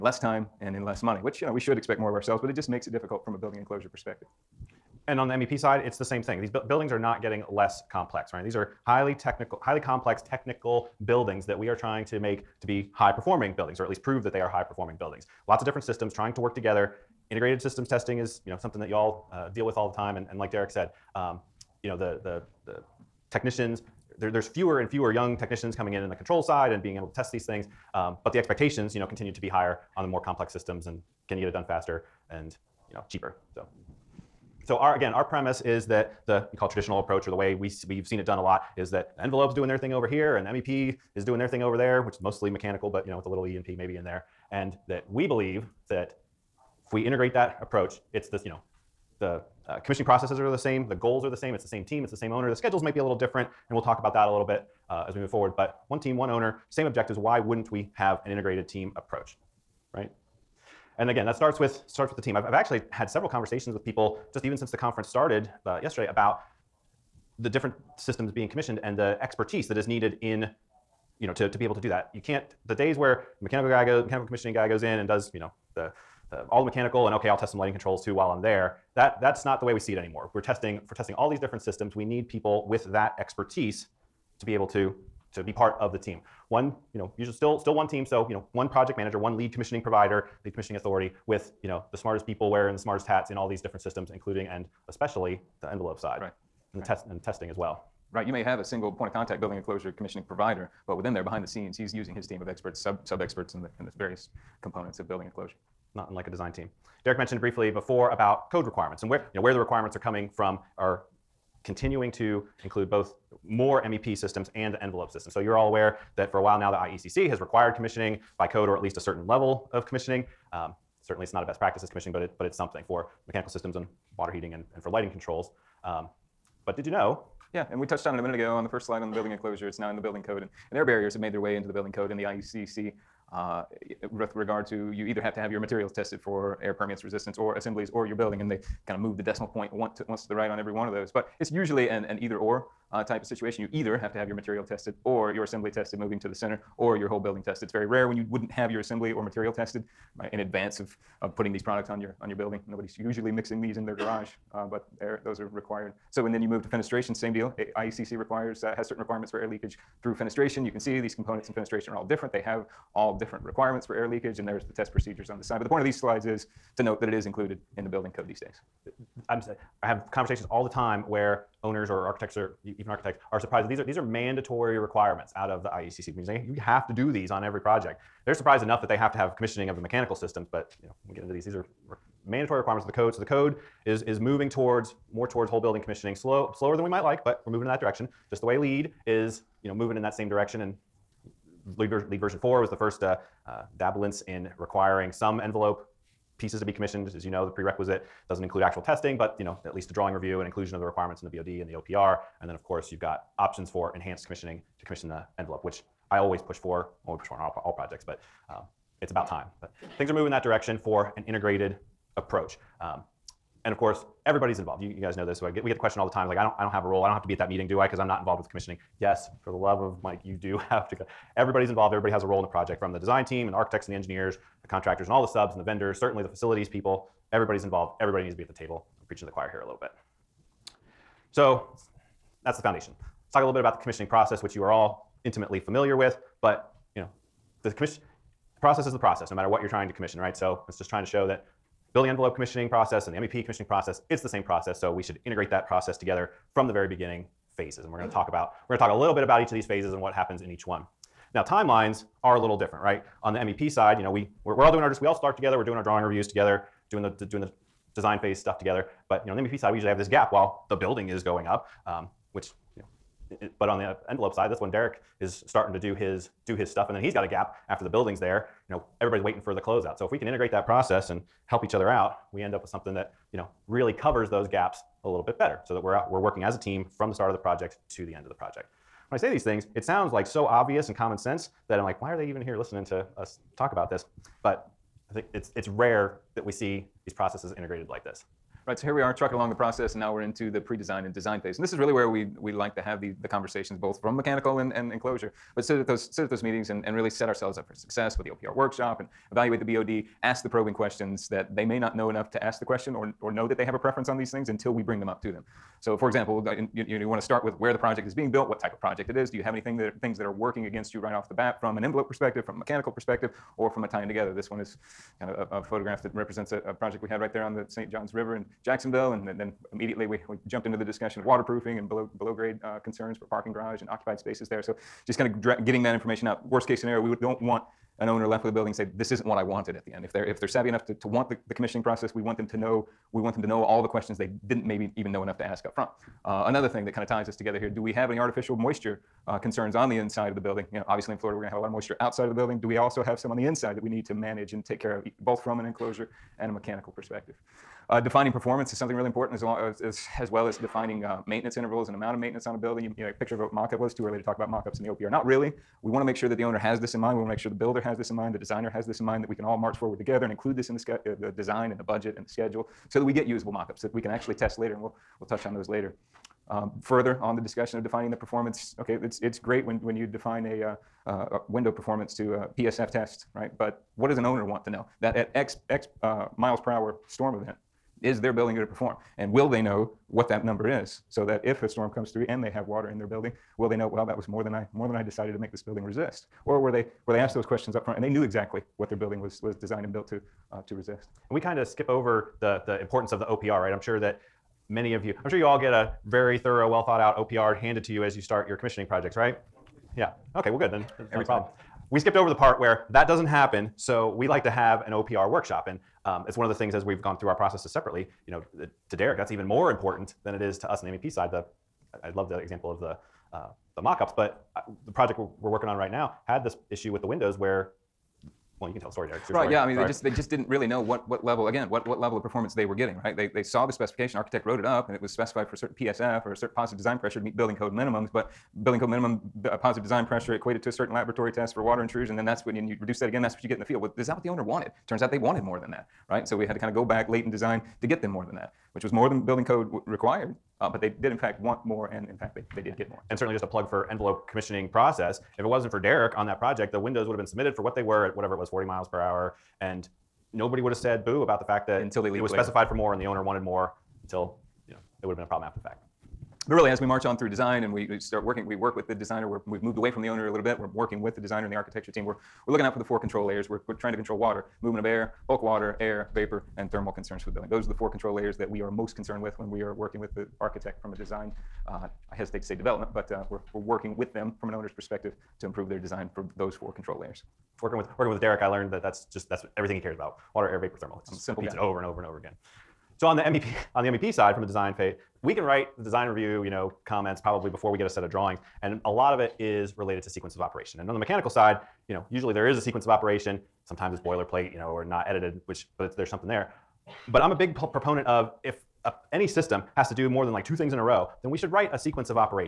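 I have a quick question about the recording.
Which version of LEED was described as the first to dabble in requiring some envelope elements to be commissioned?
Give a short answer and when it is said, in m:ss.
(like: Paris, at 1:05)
LEED version 4, at 3:12.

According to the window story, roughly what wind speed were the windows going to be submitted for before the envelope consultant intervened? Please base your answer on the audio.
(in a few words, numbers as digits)
40 miles per hour.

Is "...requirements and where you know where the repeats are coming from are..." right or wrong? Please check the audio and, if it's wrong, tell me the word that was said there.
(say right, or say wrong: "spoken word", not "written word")
wrong: "requirements", not "repeats".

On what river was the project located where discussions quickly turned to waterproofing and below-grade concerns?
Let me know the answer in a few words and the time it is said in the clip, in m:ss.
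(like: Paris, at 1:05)
St. John's River, at 5:17.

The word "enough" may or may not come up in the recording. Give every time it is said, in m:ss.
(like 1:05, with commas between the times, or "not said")
2:58, 5:02, 5:30, 5:35.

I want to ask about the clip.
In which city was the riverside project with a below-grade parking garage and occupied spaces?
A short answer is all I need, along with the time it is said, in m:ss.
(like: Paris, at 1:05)
Jacksonville, at 5:18.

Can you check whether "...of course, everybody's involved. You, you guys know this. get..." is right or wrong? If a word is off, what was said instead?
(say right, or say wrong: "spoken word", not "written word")
right.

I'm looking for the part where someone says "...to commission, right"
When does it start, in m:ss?
3:59.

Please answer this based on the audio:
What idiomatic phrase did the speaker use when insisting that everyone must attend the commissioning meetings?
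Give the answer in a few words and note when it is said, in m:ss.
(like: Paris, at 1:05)
for the love of Mike, at 3:39.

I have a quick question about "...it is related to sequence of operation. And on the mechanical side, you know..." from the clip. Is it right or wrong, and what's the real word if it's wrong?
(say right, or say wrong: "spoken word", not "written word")
right.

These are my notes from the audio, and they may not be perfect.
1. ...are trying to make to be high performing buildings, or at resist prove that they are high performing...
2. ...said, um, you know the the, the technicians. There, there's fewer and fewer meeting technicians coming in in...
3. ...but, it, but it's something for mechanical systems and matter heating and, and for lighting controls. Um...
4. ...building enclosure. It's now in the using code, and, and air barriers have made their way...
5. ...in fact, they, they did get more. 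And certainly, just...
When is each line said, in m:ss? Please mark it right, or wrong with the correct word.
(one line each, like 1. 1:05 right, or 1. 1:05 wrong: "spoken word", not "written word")
1. 0:11 wrong: "least", not "resist"
2. 0:20 wrong: "young", not "meeting"
3. 2:02 wrong: "water", not "matter"
4. 2:09 wrong: "building", not "using"
5. 7:22 right.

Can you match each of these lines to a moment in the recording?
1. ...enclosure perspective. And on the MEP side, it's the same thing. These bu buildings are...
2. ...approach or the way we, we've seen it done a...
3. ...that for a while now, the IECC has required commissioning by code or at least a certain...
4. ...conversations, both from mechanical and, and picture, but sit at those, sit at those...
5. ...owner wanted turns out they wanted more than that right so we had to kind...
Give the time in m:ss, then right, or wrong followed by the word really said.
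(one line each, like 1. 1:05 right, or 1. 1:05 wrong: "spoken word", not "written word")
1. 0:03 right
2. 0:36 right
3. 1:56 right
4. 4:53 wrong: "enclosure", not "picture"
5. 7:14 right.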